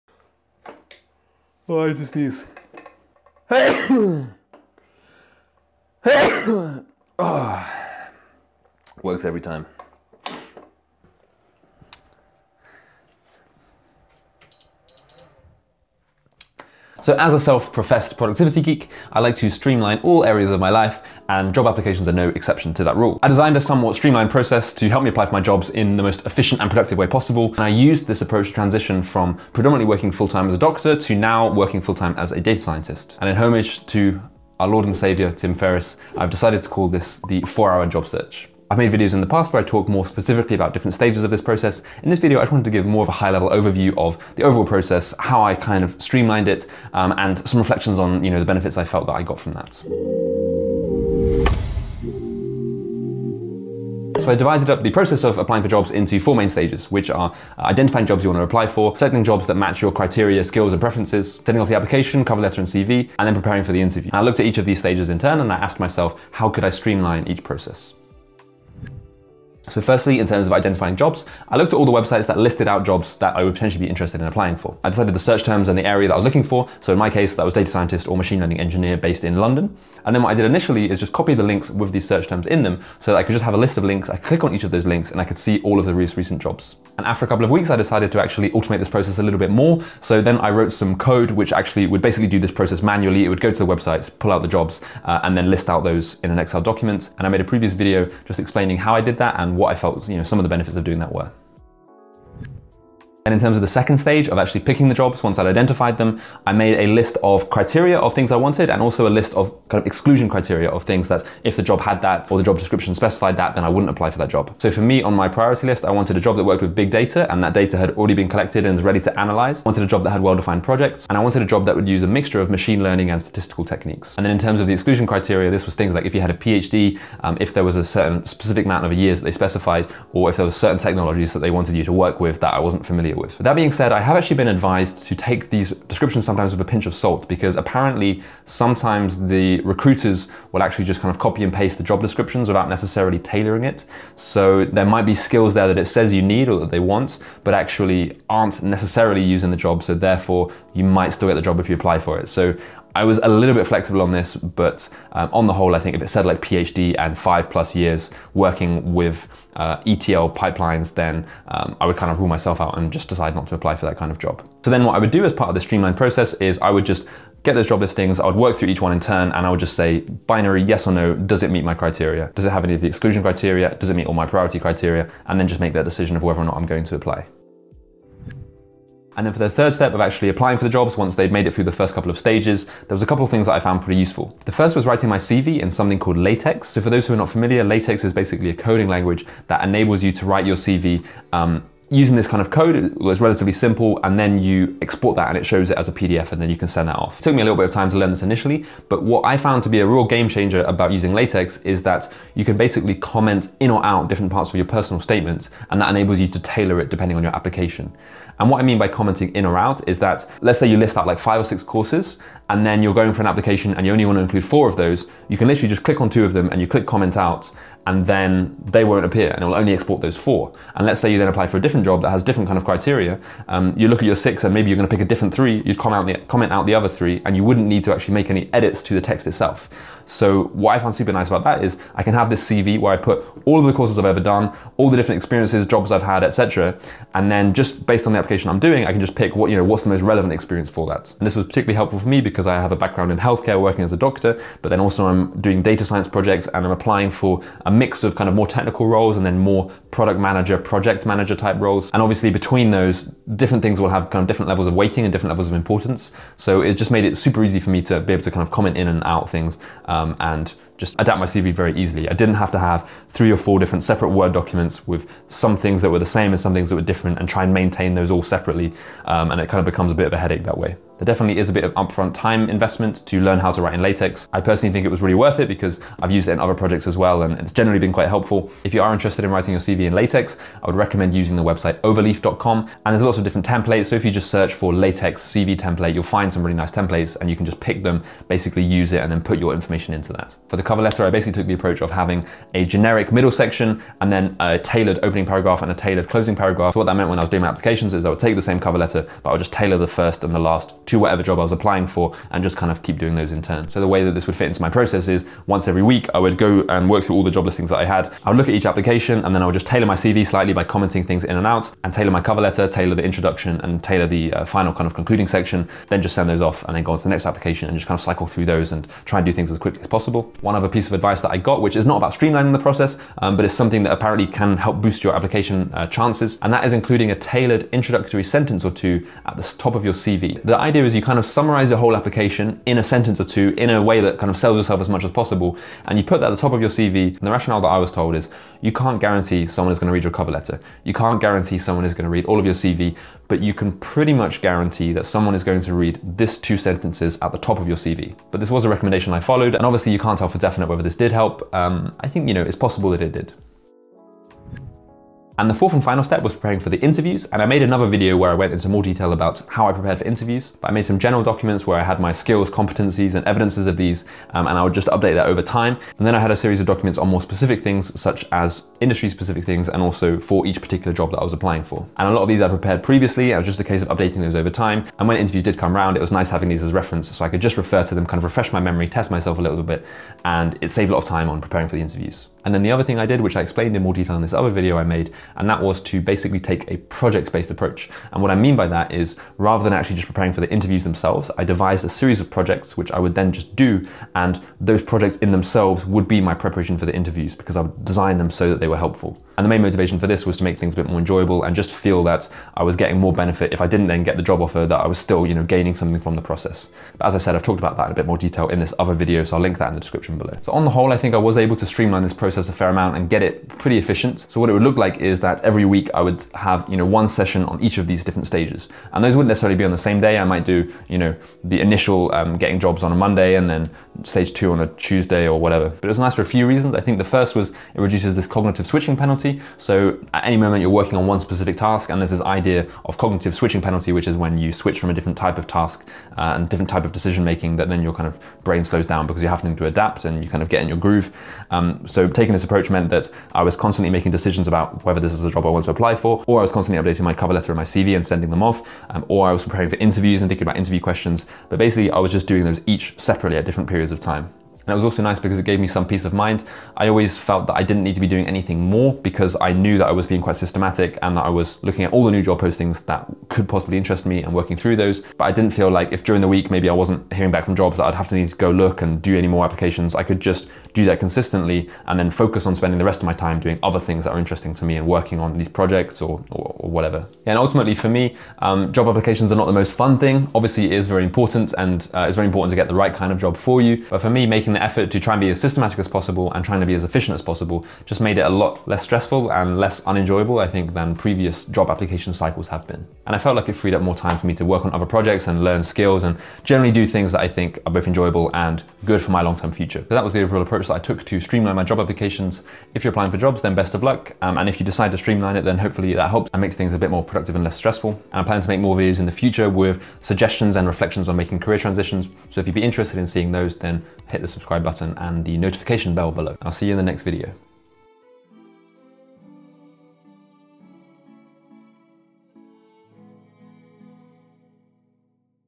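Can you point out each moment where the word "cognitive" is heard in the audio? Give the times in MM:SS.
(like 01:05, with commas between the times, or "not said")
07:08, 07:12.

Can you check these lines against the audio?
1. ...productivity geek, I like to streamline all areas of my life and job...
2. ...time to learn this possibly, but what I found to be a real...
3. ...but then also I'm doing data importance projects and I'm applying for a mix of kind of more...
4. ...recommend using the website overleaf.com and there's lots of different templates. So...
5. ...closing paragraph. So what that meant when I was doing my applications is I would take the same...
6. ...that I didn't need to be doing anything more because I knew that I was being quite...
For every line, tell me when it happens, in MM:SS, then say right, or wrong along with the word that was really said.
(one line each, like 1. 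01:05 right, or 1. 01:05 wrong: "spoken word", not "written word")
1. 00:18 right
2. 03:17 wrong: "initially", not "possibly"
3. 04:04 wrong: "science", not "importance"
4. 04:40 right
5. 04:56 right
6. 07:37 right.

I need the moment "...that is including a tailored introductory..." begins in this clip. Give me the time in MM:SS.
05:26.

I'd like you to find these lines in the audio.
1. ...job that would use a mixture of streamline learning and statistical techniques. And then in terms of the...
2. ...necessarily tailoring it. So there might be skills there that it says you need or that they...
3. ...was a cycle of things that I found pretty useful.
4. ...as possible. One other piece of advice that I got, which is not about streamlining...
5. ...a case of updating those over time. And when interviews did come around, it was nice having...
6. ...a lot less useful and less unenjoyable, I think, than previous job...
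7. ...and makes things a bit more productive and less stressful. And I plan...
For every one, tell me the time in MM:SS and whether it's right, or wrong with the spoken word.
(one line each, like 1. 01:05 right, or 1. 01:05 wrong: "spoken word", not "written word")
1. 02:01 wrong: "machine", not "streamline"
2. 02:22 right
3. 03:02 wrong: "couple", not "cycle"
4. 05:19 right
5. 06:13 right
6. 08:08 wrong: "stressful", not "useful"
7. 08:26 right.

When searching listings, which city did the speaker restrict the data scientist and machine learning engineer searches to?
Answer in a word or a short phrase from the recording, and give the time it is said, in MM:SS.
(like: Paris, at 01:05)
London, at 01:19.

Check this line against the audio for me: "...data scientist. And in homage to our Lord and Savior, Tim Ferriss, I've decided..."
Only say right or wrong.
right.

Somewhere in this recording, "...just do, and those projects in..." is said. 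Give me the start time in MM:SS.
06:33.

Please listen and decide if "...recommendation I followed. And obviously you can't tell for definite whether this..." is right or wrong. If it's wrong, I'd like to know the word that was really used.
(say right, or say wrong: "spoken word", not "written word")
right.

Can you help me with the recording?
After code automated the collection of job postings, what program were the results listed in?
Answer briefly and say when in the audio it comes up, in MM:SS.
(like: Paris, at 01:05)
Excel, at 01:36.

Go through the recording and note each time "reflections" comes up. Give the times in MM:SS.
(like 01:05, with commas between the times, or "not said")
00:47, 08:30.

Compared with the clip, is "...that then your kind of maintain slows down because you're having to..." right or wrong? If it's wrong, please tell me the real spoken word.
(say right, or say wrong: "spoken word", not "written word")
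wrong: "brain", not "maintain".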